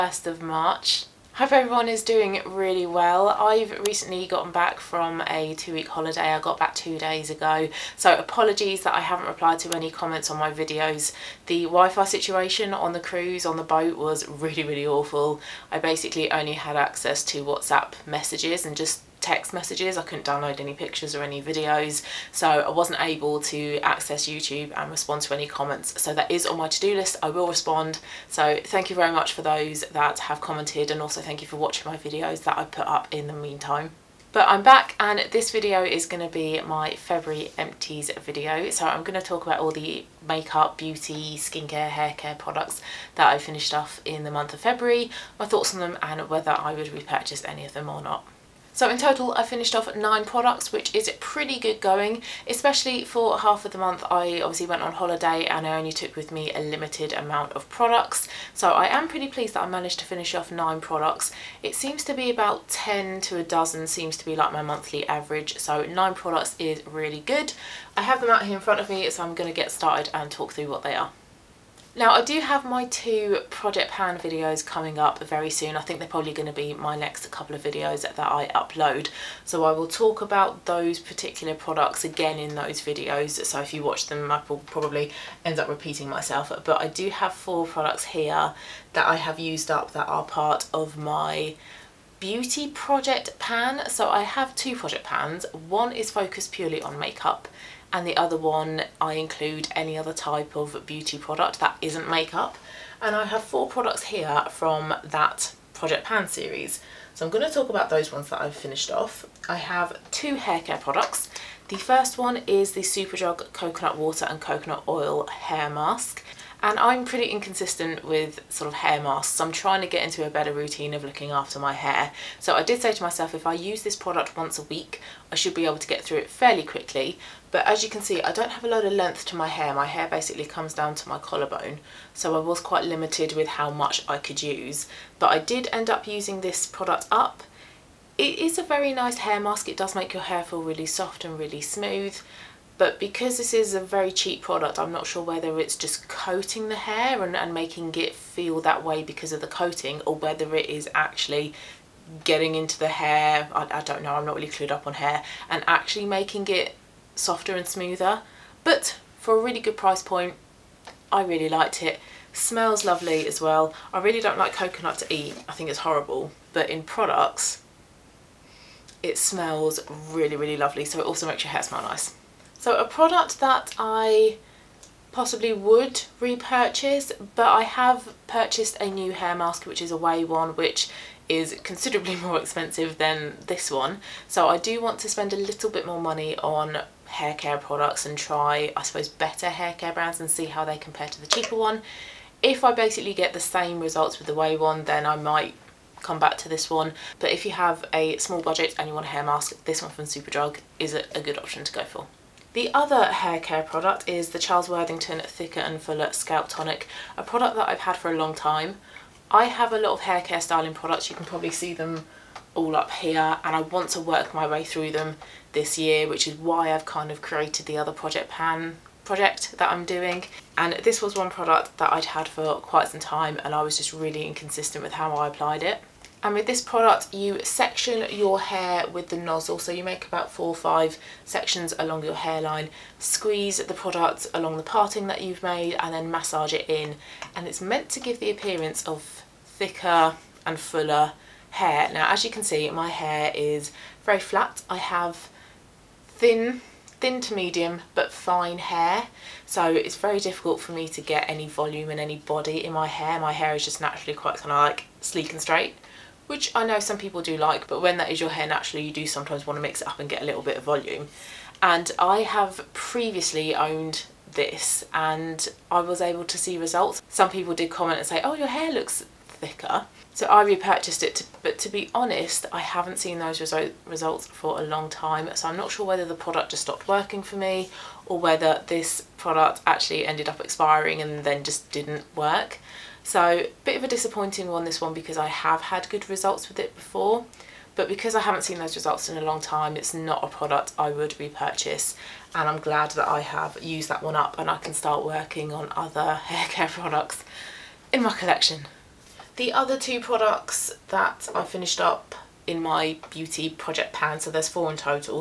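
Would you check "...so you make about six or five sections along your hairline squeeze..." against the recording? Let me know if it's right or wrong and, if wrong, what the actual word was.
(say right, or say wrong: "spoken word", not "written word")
wrong: "four", not "six".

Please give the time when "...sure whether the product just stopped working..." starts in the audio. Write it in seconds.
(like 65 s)
275 s.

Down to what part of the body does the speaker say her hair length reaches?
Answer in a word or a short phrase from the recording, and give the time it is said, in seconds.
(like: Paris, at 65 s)
Collarbone, at 131 s.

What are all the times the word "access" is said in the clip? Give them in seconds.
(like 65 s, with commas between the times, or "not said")
16 s, 23 s.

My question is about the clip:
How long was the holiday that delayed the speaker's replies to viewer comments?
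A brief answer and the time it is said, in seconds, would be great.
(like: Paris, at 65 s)
2 weeks, at 5 s.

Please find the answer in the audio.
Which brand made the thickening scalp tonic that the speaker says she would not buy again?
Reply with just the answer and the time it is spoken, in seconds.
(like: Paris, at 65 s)
Charles Worthington, at 204 s.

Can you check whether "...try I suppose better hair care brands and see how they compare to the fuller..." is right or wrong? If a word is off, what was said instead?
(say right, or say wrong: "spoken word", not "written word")
wrong: "cheaper", not "fuller".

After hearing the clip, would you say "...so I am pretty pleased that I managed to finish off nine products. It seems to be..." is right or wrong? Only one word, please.
right.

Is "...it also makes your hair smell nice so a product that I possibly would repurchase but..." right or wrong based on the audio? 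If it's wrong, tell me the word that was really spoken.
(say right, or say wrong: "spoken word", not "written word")
right.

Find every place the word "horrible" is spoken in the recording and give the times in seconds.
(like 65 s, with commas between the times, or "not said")
165 s.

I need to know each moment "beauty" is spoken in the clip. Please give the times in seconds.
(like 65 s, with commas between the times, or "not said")
40 s, 92 s, 100 s, 303 s.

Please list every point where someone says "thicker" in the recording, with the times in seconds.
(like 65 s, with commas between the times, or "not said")
205 s, 239 s, 269 s.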